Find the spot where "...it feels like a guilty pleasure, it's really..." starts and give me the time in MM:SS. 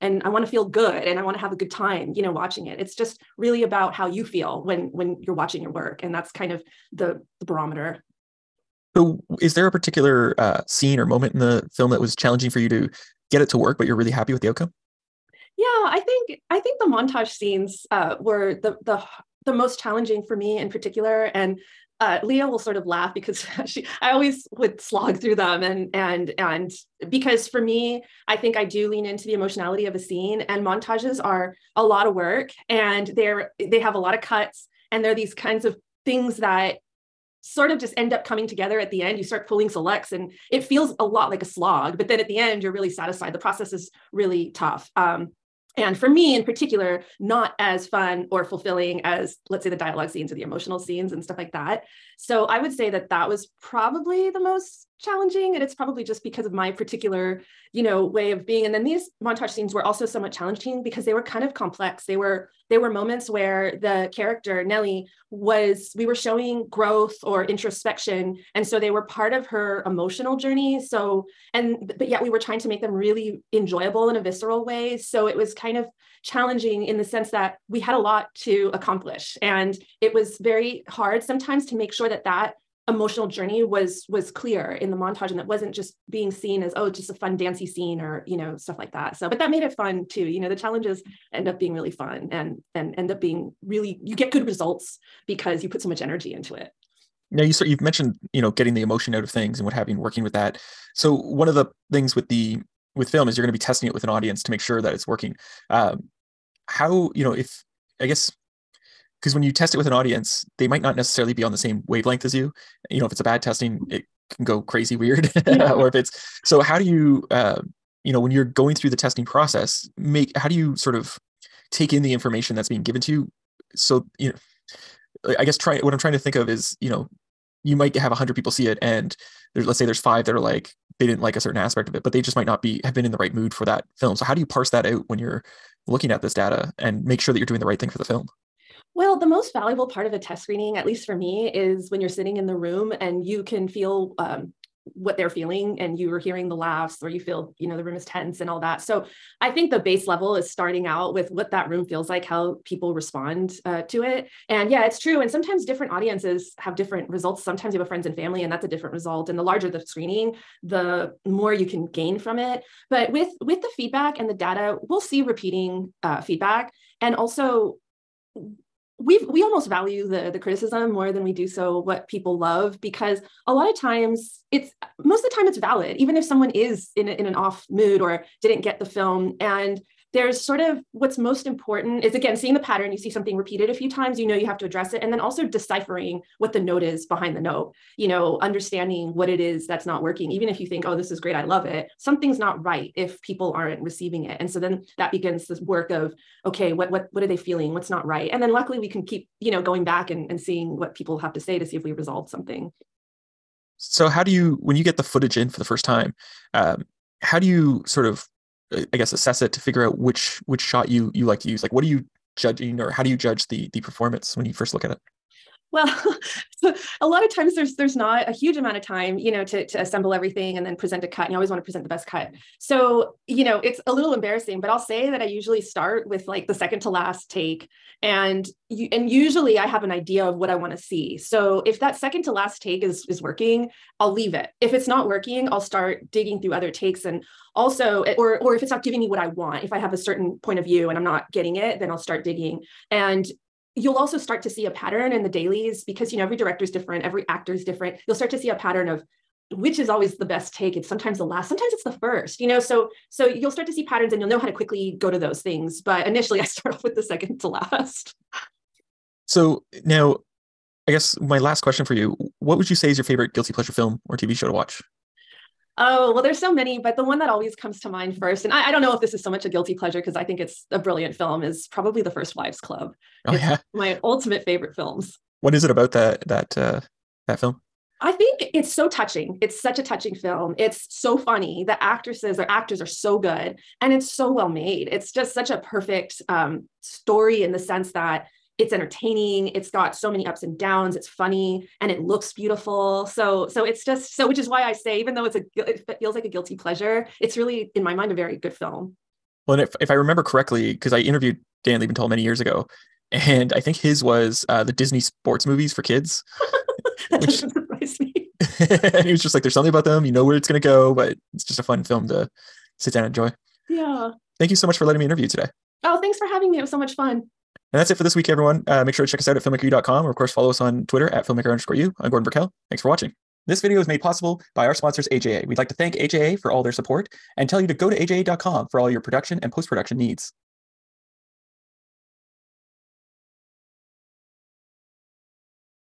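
04:55.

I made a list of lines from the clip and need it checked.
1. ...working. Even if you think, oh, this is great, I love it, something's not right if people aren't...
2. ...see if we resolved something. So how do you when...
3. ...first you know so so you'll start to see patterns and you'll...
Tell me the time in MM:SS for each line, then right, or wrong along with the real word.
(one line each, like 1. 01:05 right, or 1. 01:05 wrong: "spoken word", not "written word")
1. 03:10 right
2. 03:21 right
3. 04:12 right.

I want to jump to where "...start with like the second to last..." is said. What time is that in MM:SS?
03:45.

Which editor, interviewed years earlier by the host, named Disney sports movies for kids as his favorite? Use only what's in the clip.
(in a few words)
Dan Lebental.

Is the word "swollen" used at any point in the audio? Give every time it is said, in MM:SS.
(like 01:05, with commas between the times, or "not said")
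not said.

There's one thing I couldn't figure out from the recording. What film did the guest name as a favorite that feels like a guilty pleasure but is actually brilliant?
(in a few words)
The First Wives Club.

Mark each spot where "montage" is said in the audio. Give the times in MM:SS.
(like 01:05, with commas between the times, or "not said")
00:16, 00:30, 00:59, 01:24.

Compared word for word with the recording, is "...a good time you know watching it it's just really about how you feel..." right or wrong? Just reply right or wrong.
right.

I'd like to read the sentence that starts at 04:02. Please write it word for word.
And you'll also start to see a pattern in the dailies because you know every director is different, every actor is different.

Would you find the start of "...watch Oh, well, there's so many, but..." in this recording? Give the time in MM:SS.
04:24.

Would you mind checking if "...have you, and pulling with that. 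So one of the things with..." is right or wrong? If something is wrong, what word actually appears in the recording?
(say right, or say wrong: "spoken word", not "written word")
wrong: "working", not "pulling".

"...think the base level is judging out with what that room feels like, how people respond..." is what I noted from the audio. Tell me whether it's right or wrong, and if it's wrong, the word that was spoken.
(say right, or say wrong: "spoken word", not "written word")
wrong: "starting", not "judging".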